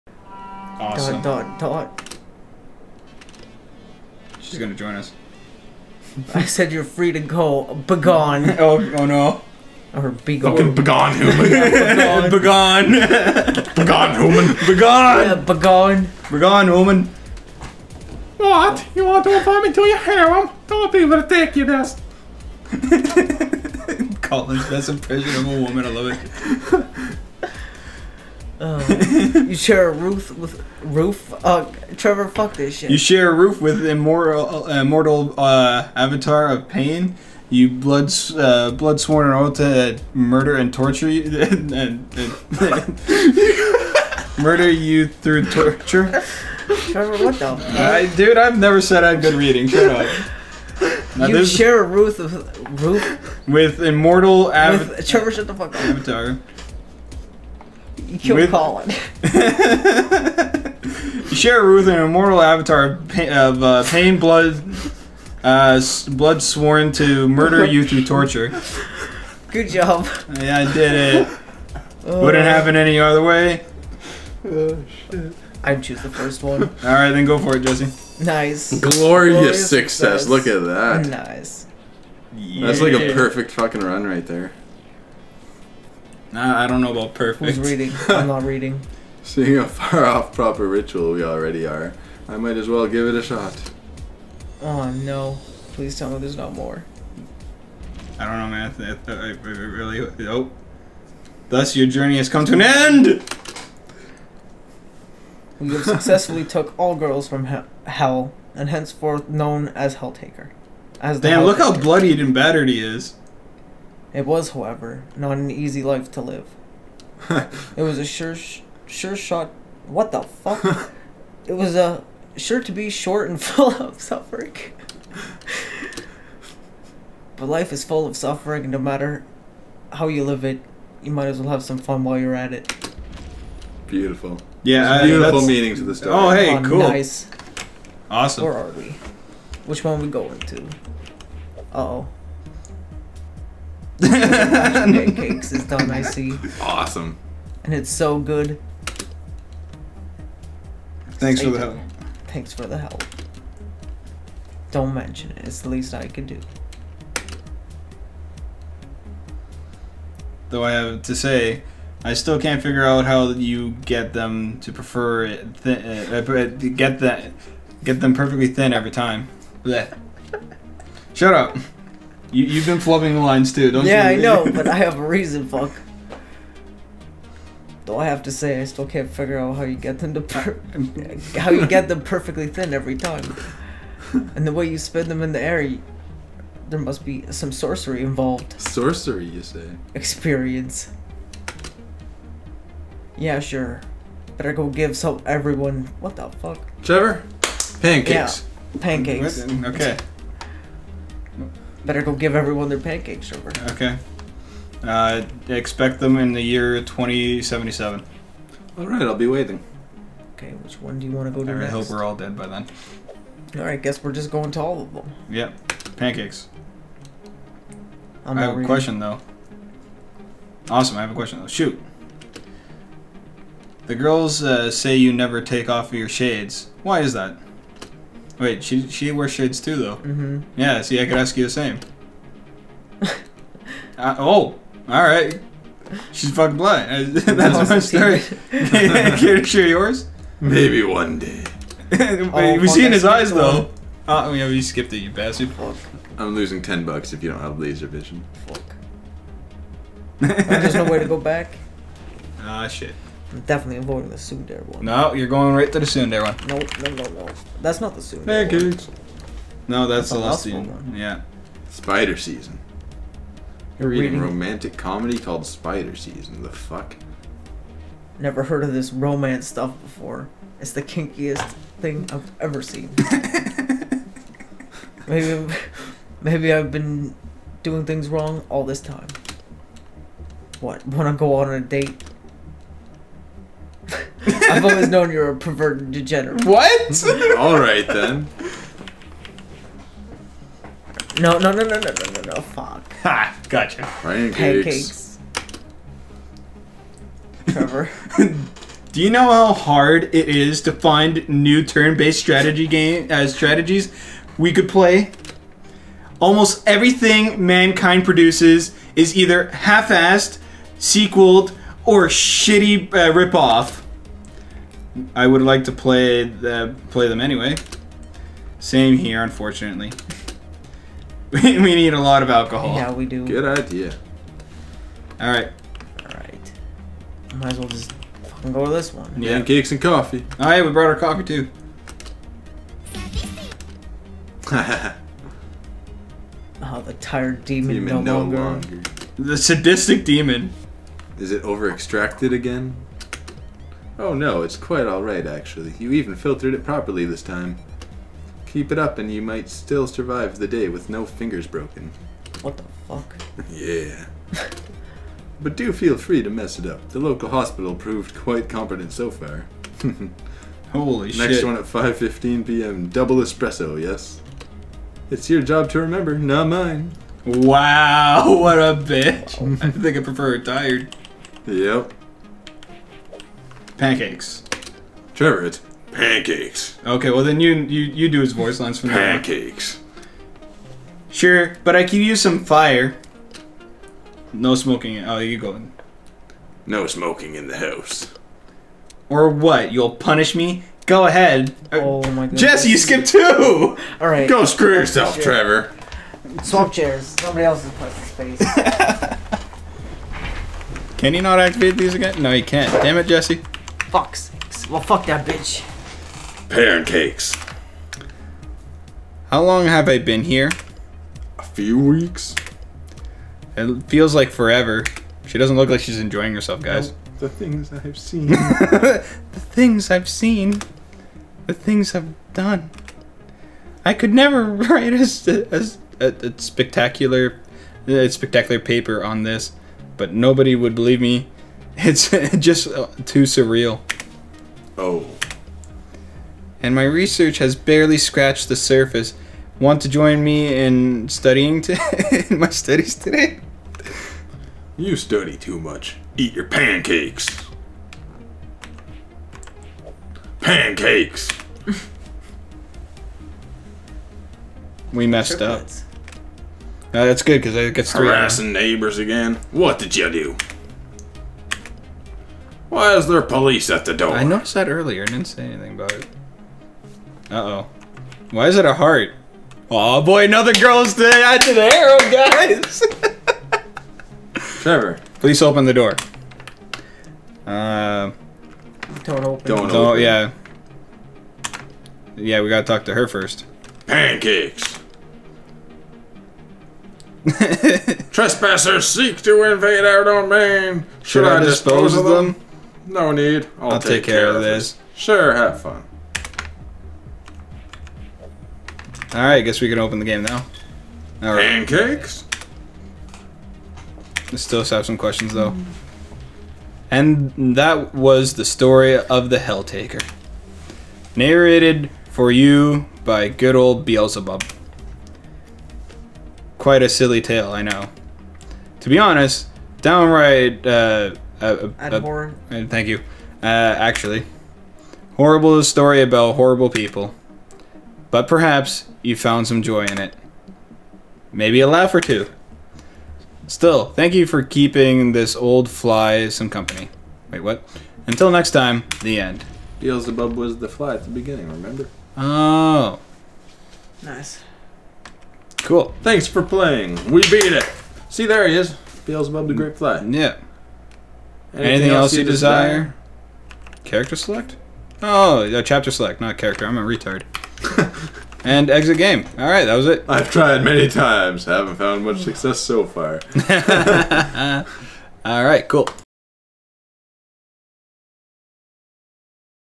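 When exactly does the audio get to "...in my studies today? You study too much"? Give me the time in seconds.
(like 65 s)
442 s.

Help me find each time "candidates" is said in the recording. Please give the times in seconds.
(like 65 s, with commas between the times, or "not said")
not said.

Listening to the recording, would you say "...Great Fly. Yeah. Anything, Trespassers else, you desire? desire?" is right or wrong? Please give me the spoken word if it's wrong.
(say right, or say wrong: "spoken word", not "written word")
wrong: "Anything", not "Trespassers".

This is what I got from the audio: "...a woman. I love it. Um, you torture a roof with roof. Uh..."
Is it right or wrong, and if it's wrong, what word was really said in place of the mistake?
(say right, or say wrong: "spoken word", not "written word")
wrong: "share", not "torture".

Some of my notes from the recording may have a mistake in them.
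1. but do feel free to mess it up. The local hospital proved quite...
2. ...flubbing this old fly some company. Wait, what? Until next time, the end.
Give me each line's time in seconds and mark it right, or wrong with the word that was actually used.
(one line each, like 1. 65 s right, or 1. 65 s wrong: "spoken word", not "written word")
1. 355 s right
2. 534 s wrong: "keeping", not "flubbing".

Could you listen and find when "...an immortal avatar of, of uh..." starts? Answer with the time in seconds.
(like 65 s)
61 s.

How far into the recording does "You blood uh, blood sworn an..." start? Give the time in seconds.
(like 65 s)
37 s.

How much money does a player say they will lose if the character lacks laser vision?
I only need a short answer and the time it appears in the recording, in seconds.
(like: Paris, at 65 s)
10 dollars, at 246 s.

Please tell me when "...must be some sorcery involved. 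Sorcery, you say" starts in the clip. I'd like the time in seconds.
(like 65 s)
186 s.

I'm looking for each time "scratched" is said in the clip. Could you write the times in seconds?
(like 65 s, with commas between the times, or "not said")
437 s.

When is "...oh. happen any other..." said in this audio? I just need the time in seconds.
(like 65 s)
72 s.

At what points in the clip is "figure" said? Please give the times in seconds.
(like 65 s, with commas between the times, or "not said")
162 s, 179 s.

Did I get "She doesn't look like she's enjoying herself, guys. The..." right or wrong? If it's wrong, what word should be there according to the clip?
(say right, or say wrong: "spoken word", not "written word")
right.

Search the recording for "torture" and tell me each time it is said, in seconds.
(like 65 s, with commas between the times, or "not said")
40 s, 45 s, 68 s.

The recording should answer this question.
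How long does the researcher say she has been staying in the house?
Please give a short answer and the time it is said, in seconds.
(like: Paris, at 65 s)
A few weeks, at 411 s.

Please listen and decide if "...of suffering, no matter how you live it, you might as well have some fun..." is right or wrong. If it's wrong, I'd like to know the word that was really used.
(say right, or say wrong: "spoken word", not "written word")
right.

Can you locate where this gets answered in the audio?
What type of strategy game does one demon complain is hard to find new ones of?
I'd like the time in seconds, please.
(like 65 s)
301 s.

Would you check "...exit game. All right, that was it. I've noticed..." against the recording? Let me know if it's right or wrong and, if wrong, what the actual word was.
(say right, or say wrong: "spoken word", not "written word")
wrong: "tried", not "noticed".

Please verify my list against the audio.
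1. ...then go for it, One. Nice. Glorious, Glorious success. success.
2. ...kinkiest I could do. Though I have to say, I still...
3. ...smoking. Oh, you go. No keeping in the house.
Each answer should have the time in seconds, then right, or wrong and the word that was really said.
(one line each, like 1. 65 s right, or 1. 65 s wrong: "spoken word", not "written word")
1. 77 s wrong: "Jesse", not "One"
2. 155 s wrong: "least", not "kinkiest"
3. 384 s wrong: "smoking", not "keeping".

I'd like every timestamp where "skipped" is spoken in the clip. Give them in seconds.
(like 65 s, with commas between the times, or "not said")
244 s, 392 s.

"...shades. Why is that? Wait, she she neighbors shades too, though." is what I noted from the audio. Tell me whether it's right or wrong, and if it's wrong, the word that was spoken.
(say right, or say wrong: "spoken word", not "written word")
wrong: "wears", not "neighbors".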